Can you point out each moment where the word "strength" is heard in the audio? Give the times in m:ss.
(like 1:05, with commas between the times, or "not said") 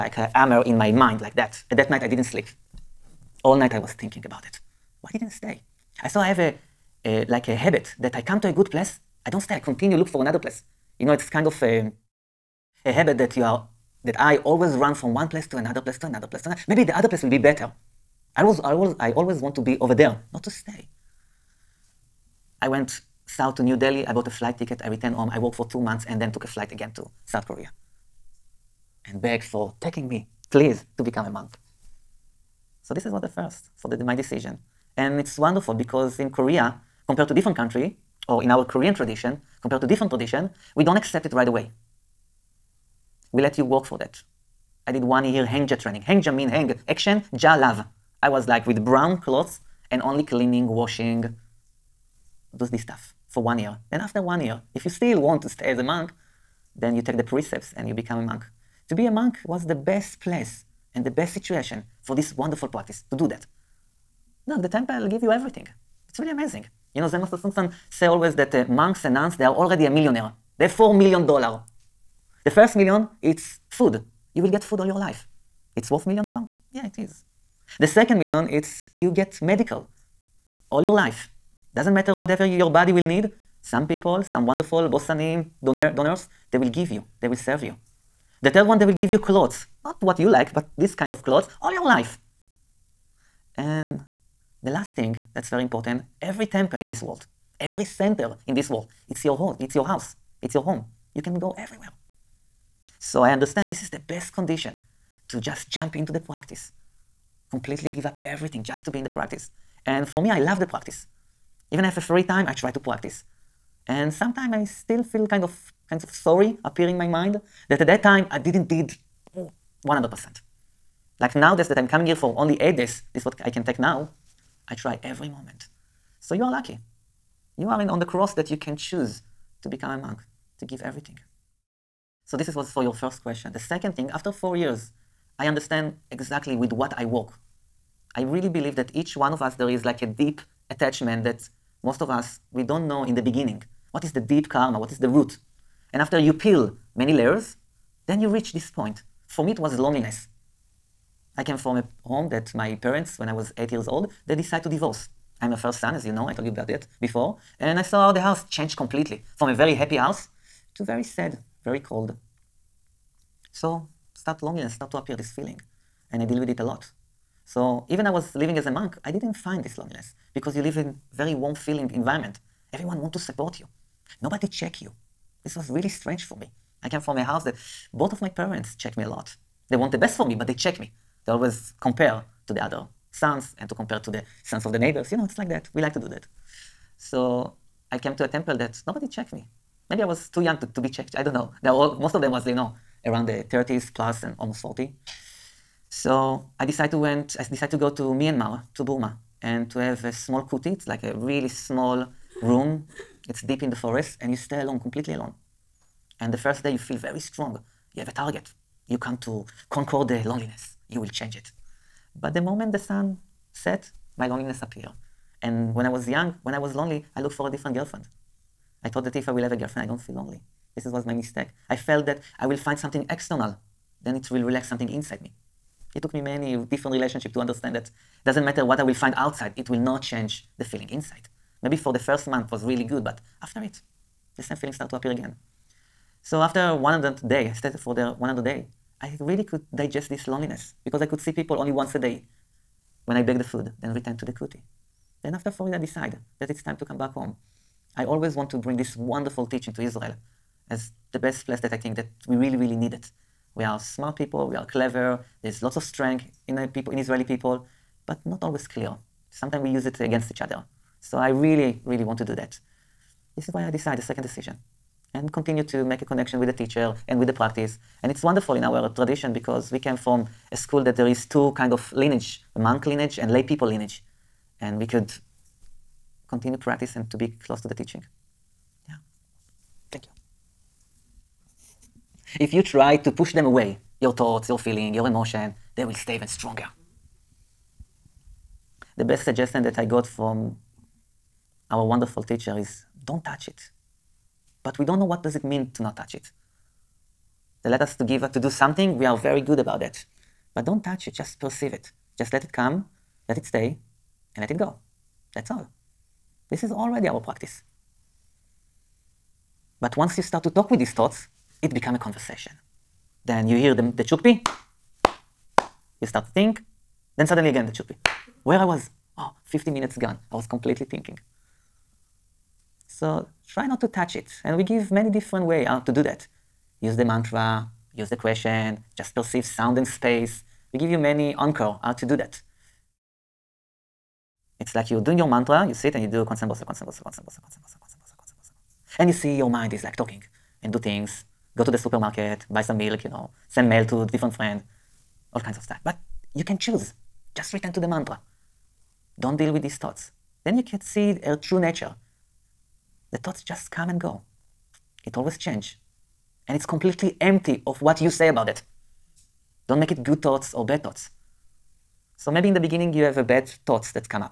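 4:15.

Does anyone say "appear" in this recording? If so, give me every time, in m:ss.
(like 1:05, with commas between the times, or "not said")
1:56, 2:44, 3:34, 3:54.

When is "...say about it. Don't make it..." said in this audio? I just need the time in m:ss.
5:58.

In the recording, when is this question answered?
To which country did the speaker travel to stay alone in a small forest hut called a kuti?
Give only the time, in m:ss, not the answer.
3:18.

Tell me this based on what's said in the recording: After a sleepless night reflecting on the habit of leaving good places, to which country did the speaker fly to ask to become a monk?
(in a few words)
South Korea.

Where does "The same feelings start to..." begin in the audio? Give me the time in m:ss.
3:54.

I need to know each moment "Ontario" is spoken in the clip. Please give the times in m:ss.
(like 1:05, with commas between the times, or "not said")
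not said.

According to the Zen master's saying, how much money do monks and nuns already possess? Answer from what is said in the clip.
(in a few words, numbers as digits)
4 million.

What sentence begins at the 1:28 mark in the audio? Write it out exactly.
The third one, they will give you clothes.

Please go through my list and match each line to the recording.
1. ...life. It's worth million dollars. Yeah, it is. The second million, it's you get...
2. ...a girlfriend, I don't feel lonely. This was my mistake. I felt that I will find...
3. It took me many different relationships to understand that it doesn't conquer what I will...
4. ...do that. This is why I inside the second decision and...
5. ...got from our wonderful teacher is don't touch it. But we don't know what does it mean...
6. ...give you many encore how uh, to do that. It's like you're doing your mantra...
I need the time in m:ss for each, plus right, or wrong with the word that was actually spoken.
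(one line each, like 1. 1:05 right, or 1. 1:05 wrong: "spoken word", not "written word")
1. 1:14 right
2. 3:39 right
3. 3:45 wrong: "matter", not "conquer"
4. 4:22 wrong: "decide", not "inside"
5. 4:49 right
6. 5:30 right.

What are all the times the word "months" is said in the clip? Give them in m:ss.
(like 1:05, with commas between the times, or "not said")
0:25, 3:52.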